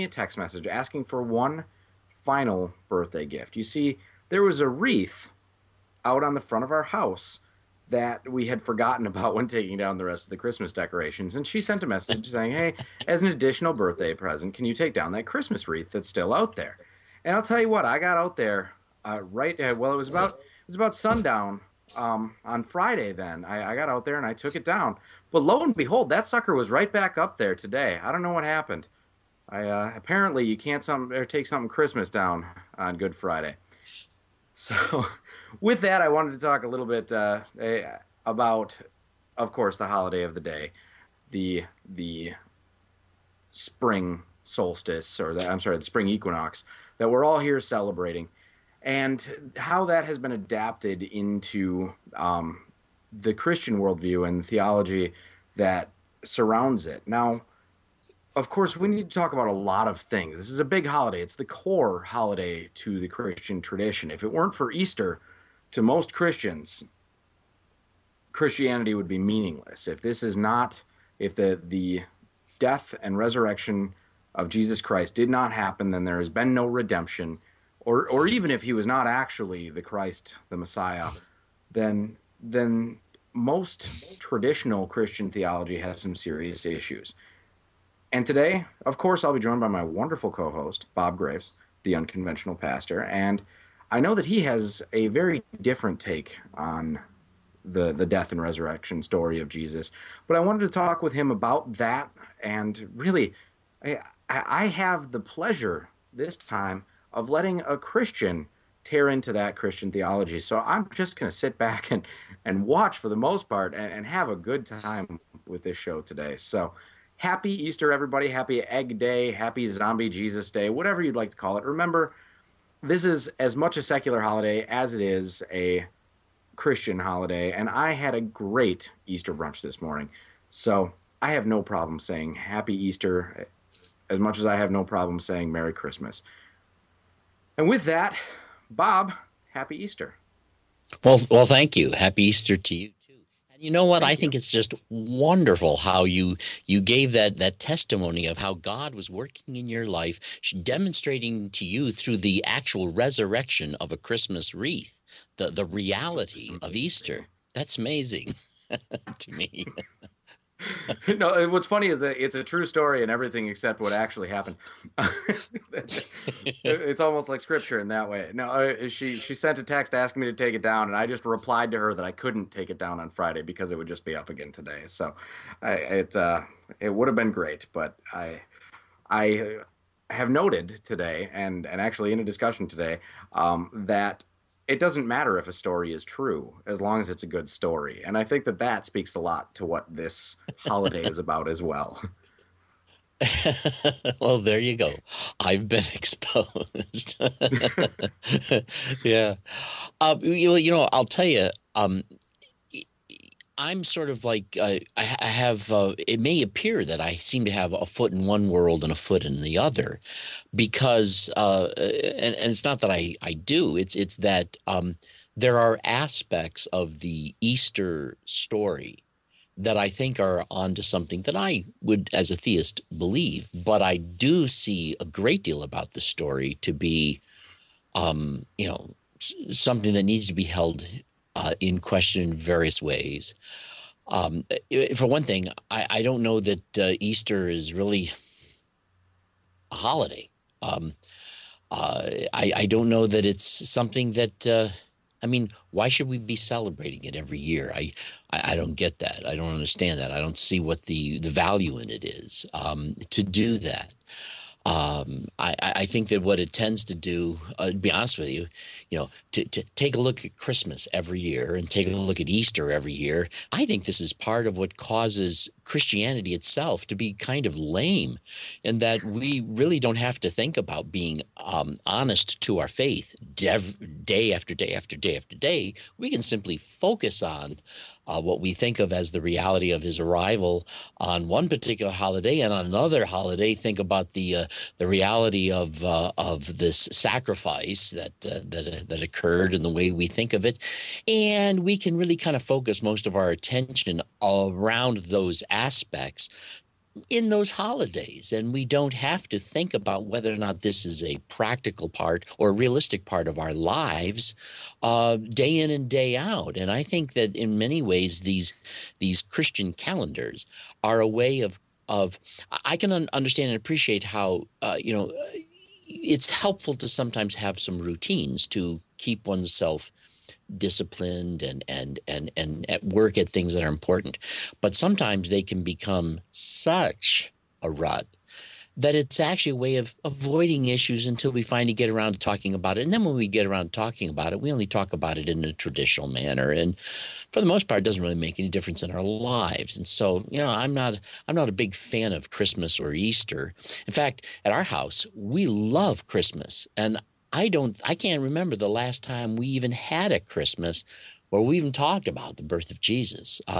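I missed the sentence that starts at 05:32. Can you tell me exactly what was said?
And then when we get around to talking about it, we only talk about it in a traditional manner.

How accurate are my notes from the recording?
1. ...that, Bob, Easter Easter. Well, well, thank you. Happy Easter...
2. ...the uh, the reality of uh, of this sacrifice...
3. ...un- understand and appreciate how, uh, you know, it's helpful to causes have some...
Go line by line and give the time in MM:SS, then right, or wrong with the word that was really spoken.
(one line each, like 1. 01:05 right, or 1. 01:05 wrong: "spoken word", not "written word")
1. 02:17 wrong: "Happy", not "Easter"
2. 04:44 right
3. 05:12 wrong: "sometimes", not "causes".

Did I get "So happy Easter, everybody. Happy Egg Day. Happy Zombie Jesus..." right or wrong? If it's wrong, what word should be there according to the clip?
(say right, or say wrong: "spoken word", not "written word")
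right.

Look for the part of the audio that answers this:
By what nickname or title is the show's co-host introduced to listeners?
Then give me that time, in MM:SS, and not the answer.
01:31.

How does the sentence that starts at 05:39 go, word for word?
And so, you know, I'm not I'm not a big fan of Christmas or Easter.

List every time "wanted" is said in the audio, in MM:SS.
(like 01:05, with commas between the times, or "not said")
00:36, 01:40.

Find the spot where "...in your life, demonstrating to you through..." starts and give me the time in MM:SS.
02:29.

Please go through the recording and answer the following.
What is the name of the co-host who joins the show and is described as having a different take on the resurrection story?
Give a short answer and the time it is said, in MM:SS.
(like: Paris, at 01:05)
Bob Greaves, at 01:30.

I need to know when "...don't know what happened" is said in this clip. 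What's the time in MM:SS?
00:28.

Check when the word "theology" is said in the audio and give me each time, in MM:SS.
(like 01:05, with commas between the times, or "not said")
00:54, 01:25, 01:49.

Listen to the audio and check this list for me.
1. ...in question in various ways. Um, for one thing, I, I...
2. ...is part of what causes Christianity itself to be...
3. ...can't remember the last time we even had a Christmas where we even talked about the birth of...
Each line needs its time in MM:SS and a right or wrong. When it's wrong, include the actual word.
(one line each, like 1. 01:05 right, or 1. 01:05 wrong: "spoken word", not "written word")
1. 03:51 right
2. 04:24 right
3. 05:47 right.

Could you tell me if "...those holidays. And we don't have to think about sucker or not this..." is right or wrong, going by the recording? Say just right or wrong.
wrong.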